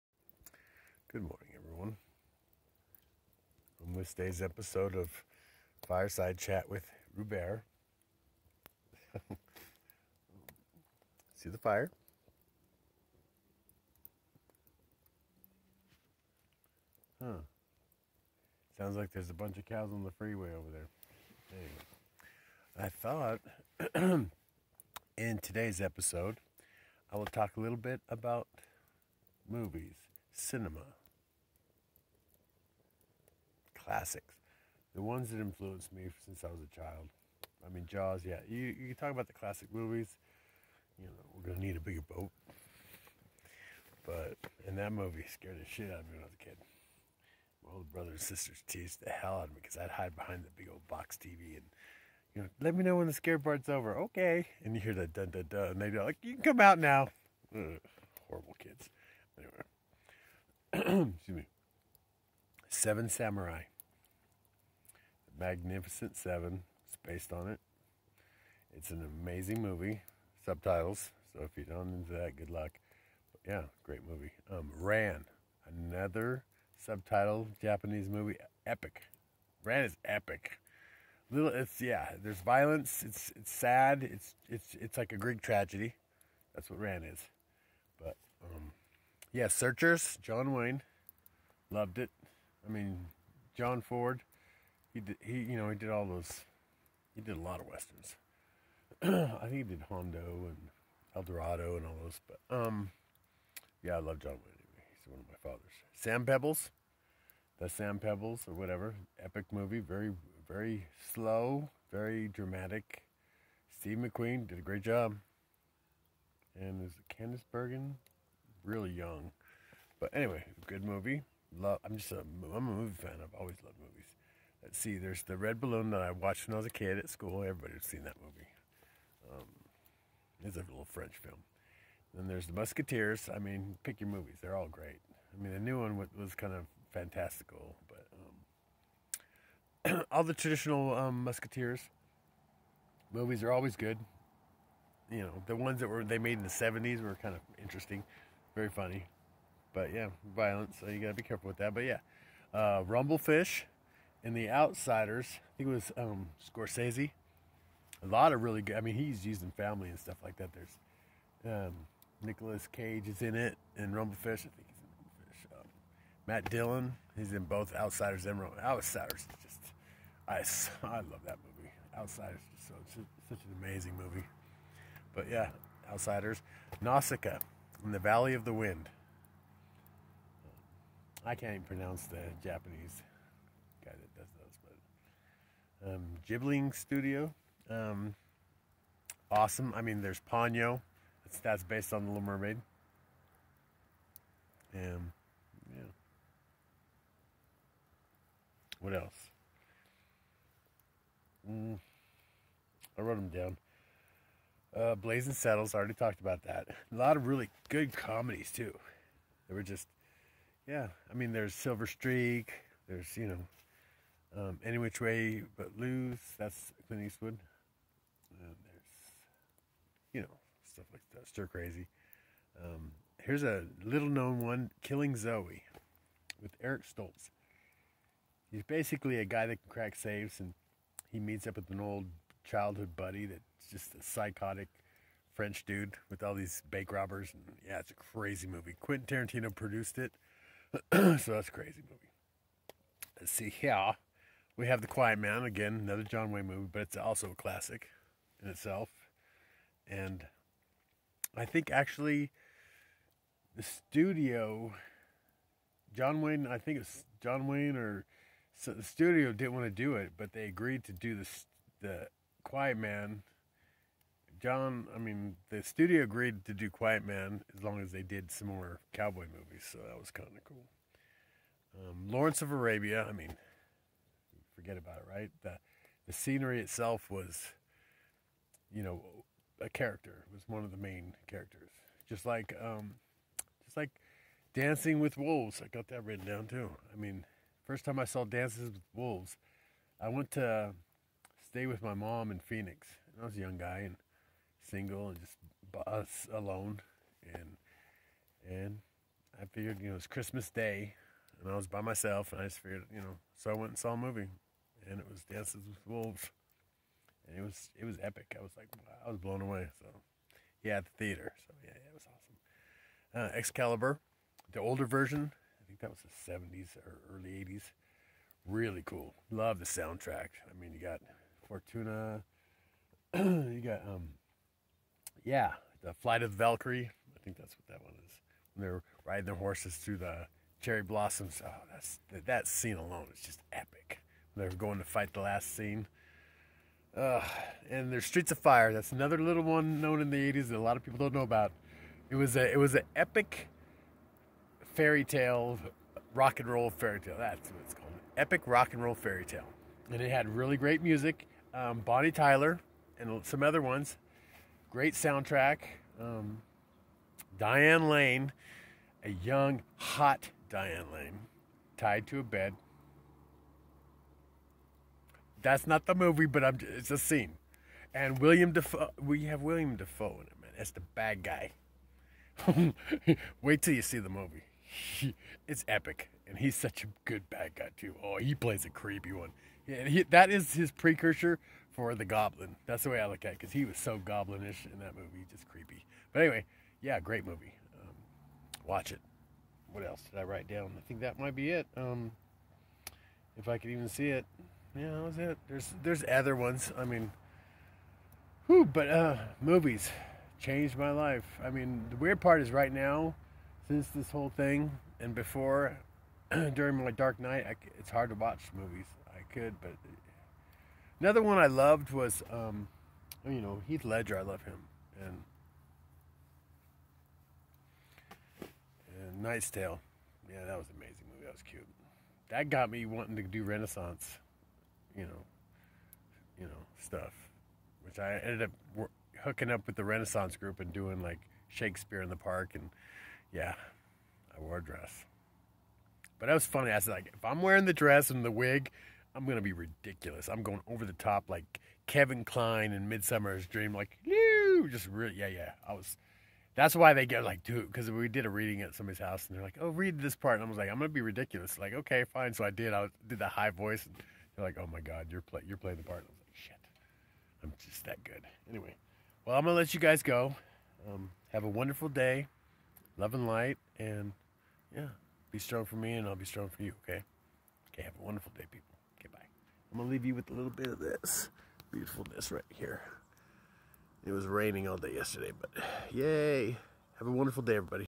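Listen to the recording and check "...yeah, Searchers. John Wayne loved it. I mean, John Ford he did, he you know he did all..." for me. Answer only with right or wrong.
right.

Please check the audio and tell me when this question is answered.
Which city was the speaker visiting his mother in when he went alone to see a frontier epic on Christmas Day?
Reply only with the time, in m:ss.
4:52.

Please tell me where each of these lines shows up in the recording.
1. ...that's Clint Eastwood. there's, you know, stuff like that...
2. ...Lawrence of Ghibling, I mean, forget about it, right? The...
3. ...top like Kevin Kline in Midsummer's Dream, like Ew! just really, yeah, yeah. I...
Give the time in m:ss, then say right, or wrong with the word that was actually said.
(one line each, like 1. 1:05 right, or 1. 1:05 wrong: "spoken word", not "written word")
1. 3:36 right
2. 4:32 wrong: "Arabia", not "Ghibling"
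3. 7:20 right.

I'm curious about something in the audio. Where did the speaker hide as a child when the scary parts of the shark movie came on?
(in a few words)
Behind the big old box TV.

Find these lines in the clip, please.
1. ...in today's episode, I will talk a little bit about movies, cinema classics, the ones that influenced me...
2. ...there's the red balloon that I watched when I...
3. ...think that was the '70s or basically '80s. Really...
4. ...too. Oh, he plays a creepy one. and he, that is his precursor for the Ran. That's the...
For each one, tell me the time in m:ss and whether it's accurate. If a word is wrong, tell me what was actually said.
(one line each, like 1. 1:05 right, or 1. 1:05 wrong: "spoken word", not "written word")
1. 0:25 right
2. 2:04 right
3. 5:15 wrong: "early", not "basically"
4. 6:17 wrong: "Goblin", not "Ran".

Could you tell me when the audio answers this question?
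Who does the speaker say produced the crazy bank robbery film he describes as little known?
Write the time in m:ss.
3:58.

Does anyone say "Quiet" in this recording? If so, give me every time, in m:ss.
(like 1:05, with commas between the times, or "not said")
4:04, 4:22, 4:26.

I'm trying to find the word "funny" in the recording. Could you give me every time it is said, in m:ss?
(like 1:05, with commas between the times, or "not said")
2:28, 7:16.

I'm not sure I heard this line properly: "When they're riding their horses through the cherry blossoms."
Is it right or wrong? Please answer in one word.
right.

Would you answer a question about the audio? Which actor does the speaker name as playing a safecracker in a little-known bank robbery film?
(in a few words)
Eric Stoltz.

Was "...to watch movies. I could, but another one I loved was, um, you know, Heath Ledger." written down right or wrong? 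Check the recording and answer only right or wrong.
right.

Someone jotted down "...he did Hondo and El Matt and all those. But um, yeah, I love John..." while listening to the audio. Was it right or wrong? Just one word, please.
wrong.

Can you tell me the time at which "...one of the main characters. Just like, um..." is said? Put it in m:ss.
4:40.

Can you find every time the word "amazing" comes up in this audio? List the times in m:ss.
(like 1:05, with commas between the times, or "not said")
1:09, 2:53, 7:00.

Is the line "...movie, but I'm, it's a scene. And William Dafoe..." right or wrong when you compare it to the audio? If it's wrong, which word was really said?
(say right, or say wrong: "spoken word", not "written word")
right.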